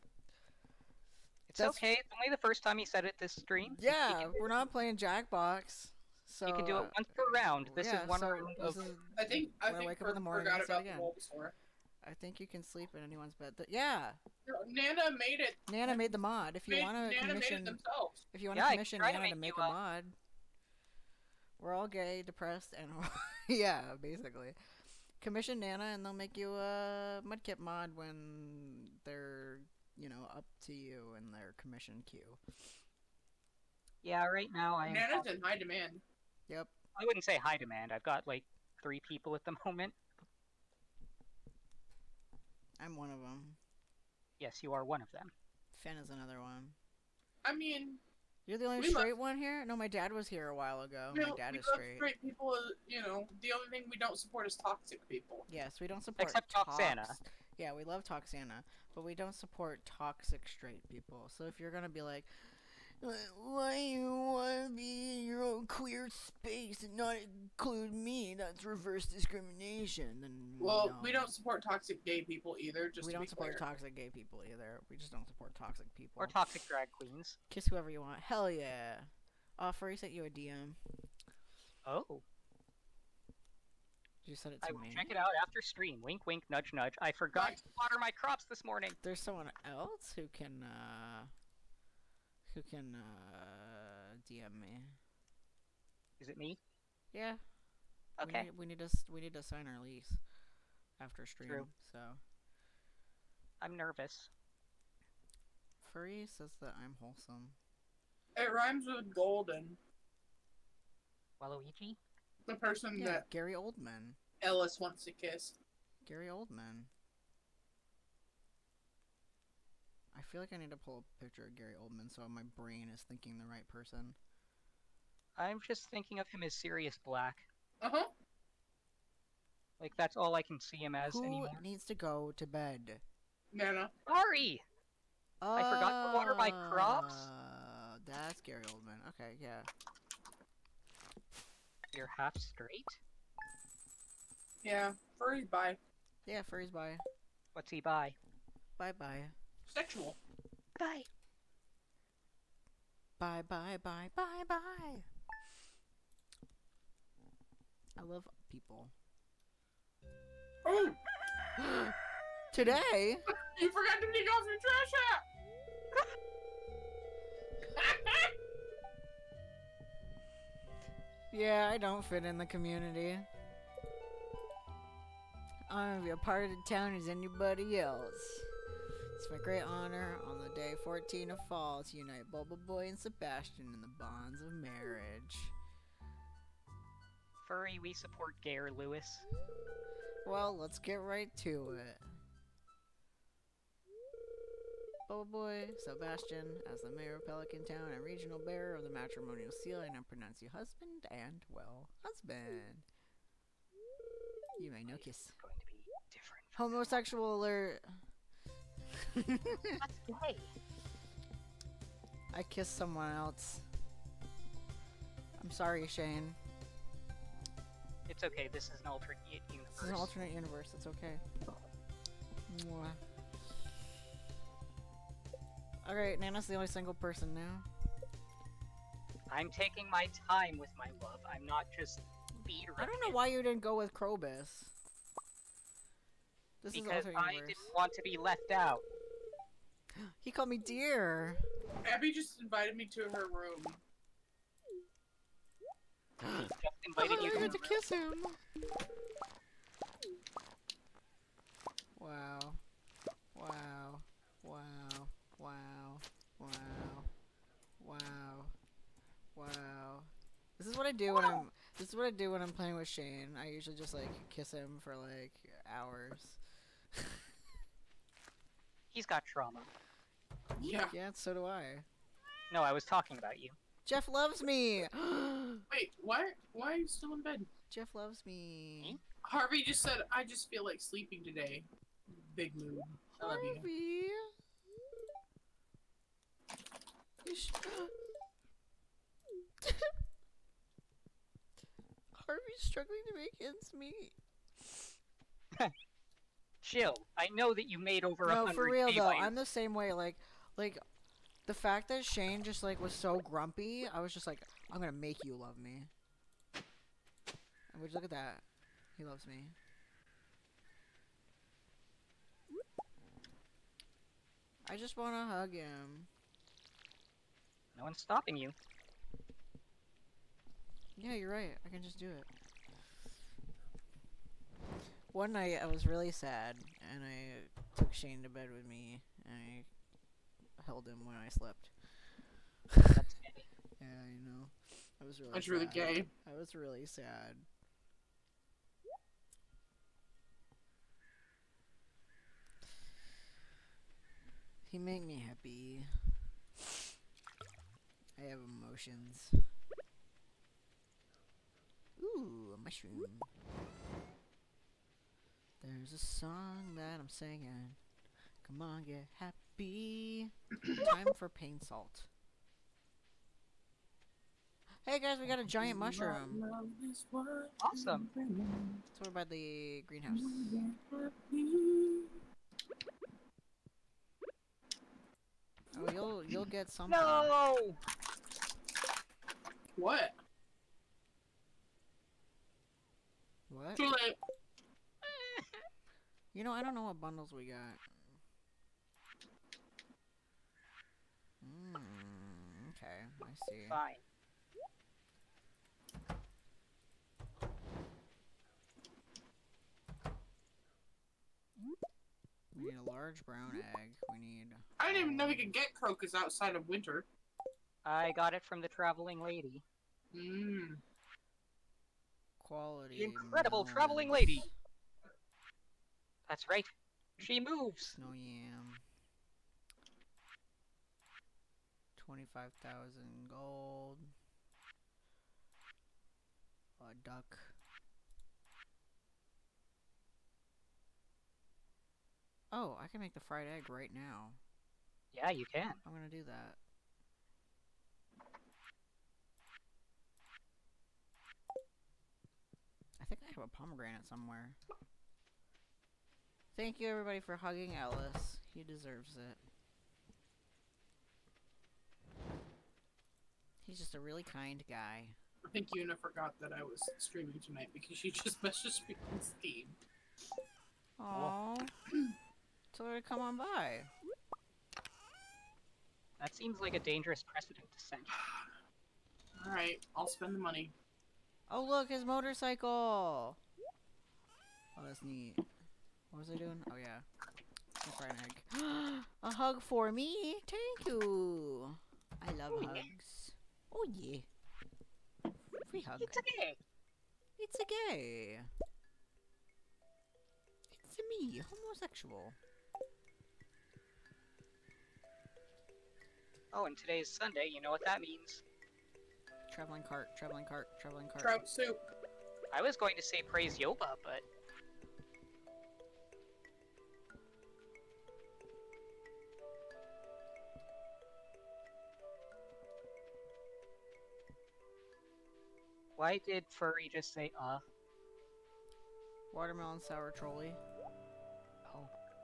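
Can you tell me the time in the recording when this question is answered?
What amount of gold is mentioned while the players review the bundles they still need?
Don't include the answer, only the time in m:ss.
7:02.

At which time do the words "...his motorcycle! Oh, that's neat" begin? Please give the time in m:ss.
7:51.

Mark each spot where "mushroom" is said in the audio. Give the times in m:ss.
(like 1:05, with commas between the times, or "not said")
5:52, 6:05.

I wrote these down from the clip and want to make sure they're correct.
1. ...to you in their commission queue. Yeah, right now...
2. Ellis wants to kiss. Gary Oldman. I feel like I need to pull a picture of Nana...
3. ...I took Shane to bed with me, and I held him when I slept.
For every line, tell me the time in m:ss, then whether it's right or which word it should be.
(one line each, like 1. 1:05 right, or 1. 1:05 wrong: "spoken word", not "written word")
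1. 0:30 right
2. 1:54 wrong: "Gary", not "Nana"
3. 5:27 right.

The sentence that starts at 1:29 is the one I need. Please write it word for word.
There's someone else who can, uh, who can, uh, DM me.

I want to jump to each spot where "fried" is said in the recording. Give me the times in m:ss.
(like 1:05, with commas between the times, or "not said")
7:13.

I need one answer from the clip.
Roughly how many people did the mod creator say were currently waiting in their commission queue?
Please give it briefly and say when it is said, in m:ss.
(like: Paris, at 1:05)
3, at 0:38.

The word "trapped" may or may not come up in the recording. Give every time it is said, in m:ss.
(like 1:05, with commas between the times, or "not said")
not said.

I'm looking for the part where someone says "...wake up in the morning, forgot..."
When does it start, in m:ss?
0:09.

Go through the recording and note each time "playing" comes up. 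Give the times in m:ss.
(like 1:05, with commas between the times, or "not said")
0:04, 4:22.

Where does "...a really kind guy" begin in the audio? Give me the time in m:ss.
7:33.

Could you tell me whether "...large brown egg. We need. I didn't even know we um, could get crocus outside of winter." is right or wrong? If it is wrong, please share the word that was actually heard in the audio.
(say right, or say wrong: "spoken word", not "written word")
right.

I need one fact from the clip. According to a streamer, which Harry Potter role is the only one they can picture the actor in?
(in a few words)
Sirius Black.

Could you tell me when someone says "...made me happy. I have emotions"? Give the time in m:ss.
5:44.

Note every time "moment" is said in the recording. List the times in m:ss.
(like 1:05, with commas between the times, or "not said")
0:39.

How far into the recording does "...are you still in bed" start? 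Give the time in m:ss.
4:36.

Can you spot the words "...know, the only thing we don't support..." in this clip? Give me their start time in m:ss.
0:53.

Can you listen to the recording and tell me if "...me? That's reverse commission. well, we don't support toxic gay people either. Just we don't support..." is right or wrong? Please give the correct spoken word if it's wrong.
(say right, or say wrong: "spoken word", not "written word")
wrong: "discrimination", not "commission".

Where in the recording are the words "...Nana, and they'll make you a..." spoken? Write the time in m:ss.
0:25.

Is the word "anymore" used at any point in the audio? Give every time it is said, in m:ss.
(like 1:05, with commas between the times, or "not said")
2:11.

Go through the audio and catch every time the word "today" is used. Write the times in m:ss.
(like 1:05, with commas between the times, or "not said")
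2:42, 4:41, 8:16.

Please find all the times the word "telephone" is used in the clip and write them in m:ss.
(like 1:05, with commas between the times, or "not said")
not said.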